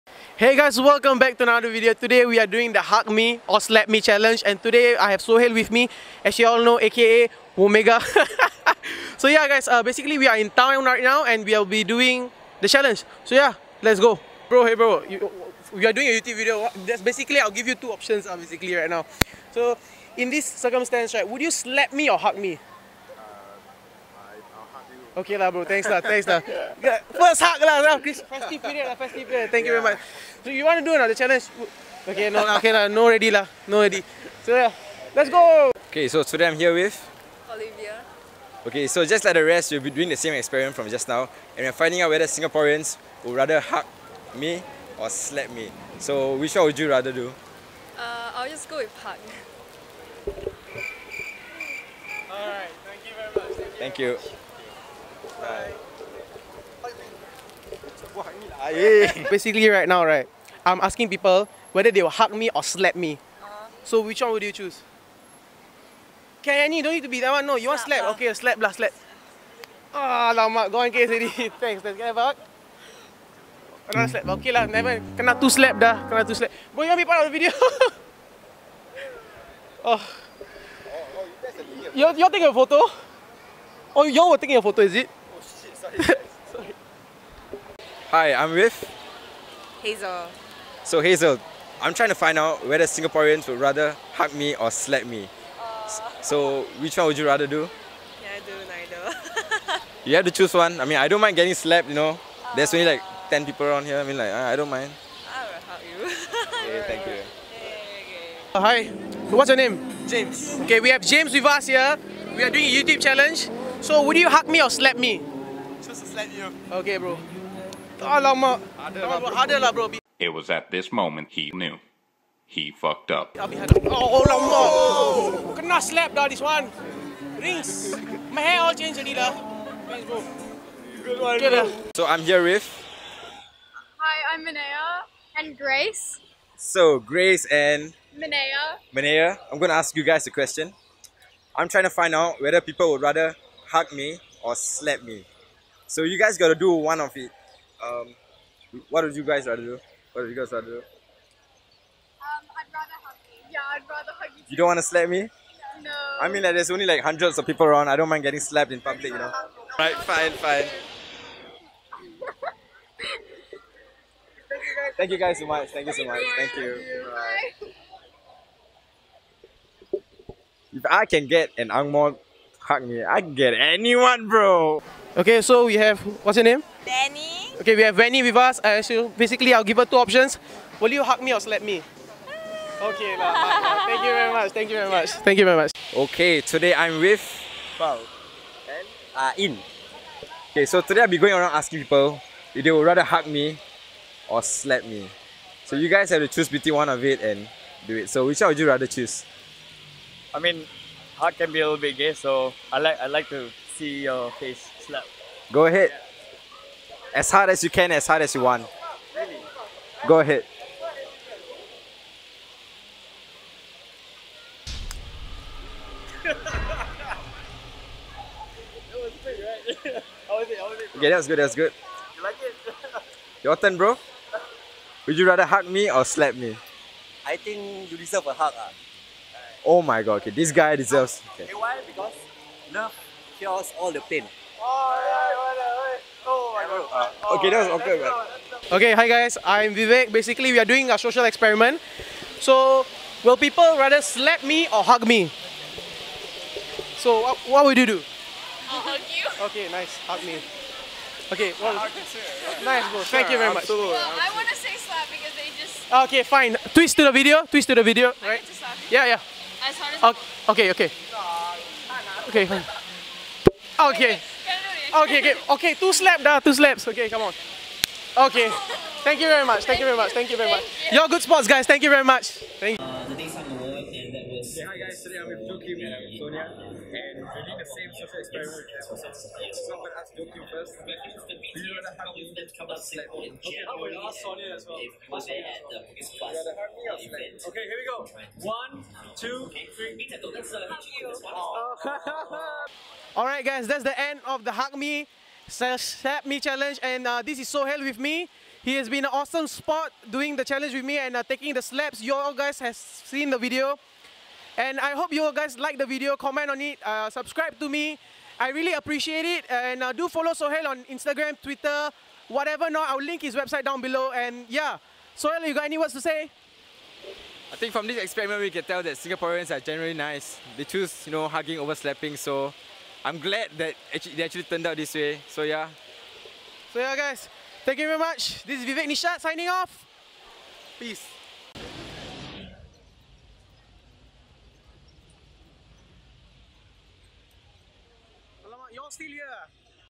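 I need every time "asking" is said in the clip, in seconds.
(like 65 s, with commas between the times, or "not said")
60 s, 191 s.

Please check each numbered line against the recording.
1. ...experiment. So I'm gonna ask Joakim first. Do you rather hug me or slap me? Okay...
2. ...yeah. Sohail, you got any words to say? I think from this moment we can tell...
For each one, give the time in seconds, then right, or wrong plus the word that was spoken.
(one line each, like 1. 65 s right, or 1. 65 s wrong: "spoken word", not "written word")
1. 278 s right
2. 314 s wrong: "experiment", not "moment".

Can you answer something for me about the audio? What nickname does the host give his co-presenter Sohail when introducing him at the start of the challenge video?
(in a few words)
Omega.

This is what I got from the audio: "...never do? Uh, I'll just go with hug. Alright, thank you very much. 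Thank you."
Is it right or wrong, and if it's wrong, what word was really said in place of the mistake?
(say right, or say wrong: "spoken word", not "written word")
wrong: "rather", not "never".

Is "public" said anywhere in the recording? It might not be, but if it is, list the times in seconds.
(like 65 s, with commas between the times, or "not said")
158 s.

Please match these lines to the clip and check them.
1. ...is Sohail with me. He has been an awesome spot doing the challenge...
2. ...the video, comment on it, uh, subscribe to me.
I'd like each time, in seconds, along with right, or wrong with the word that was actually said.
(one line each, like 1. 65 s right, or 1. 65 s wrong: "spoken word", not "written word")
1. 297 s right
2. 305 s right.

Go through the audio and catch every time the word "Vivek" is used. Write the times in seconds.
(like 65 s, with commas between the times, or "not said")
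239 s, 328 s.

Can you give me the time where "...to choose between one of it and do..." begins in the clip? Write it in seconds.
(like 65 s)
196 s.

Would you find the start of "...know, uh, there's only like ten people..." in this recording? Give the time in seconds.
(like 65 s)
101 s.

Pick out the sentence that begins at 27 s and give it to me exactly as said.
First hug lah, festive period lah, festive period.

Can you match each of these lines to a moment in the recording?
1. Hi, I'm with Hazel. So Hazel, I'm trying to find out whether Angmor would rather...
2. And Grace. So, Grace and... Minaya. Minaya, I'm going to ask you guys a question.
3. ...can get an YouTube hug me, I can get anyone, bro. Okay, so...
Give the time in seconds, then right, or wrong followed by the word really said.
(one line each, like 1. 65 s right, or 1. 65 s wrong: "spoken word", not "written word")
1. 88 s wrong: "Singaporeans", not "Angmor"
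2. 135 s right
3. 171 s wrong: "Angmor", not "YouTube".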